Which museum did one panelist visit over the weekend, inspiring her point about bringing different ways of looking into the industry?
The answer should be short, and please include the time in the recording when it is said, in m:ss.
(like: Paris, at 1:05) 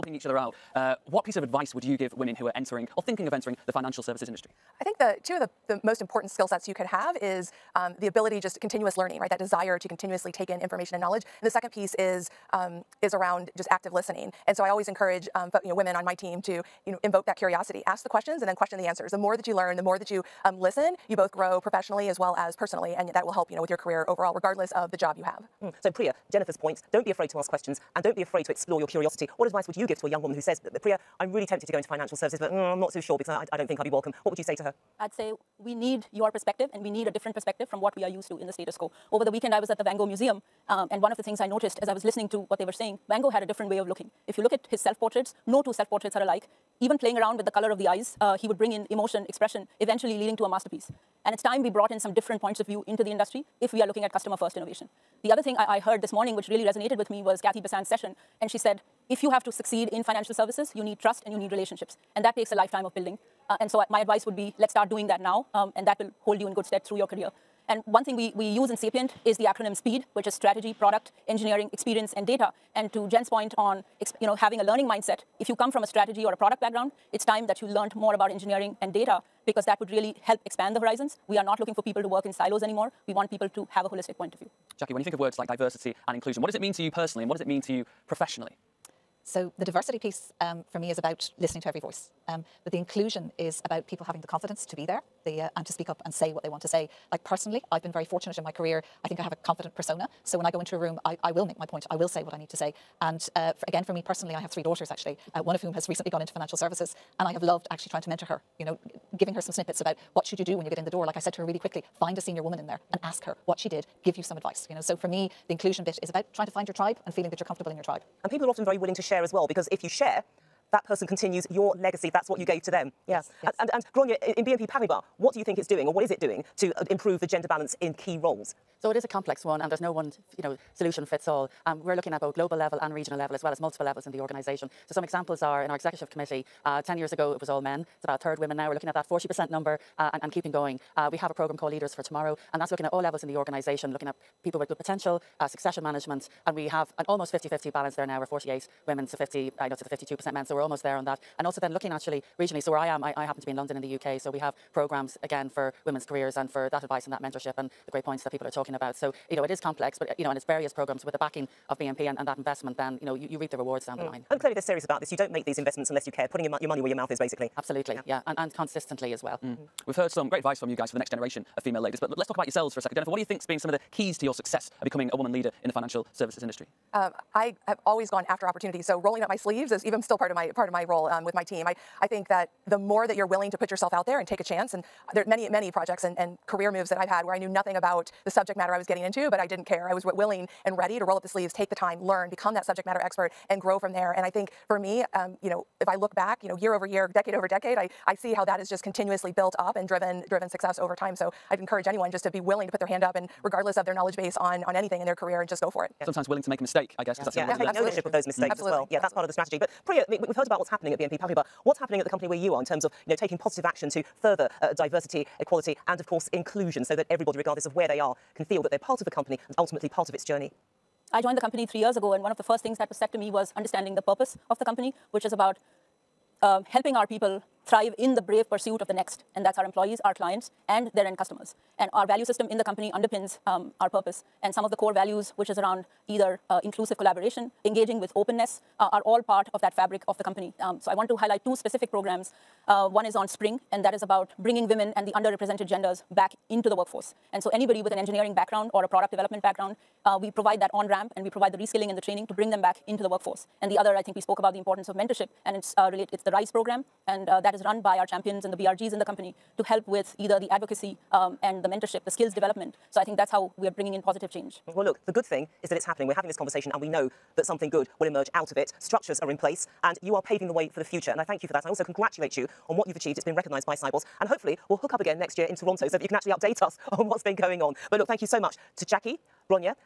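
Van Gogh Museum, at 0:39.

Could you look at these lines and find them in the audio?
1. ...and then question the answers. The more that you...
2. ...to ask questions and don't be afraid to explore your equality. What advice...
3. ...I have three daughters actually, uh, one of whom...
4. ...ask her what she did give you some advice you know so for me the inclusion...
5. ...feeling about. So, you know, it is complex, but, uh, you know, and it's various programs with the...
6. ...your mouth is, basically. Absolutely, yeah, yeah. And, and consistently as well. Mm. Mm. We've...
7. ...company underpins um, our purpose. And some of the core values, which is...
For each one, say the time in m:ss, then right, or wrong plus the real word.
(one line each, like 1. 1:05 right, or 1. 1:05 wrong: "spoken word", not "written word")
1. 0:18 right
2. 0:27 wrong: "curiosity", not "equality"
3. 1:44 right
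4. 1:53 right
5. 2:38 wrong: "talking", not "feeling"
6. 2:46 right
7. 3:52 right.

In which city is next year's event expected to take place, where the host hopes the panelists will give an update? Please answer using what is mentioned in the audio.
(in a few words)
Toronto.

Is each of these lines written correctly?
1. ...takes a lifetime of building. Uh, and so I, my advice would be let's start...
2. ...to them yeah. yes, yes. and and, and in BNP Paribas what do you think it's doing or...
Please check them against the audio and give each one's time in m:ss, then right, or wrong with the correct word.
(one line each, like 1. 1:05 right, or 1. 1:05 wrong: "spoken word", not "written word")
1. 1:02 right
2. 2:02 right.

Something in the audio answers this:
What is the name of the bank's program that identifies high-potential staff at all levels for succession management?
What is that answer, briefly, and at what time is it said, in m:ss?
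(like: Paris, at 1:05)
Leaders for Tomorrow, at 2:21.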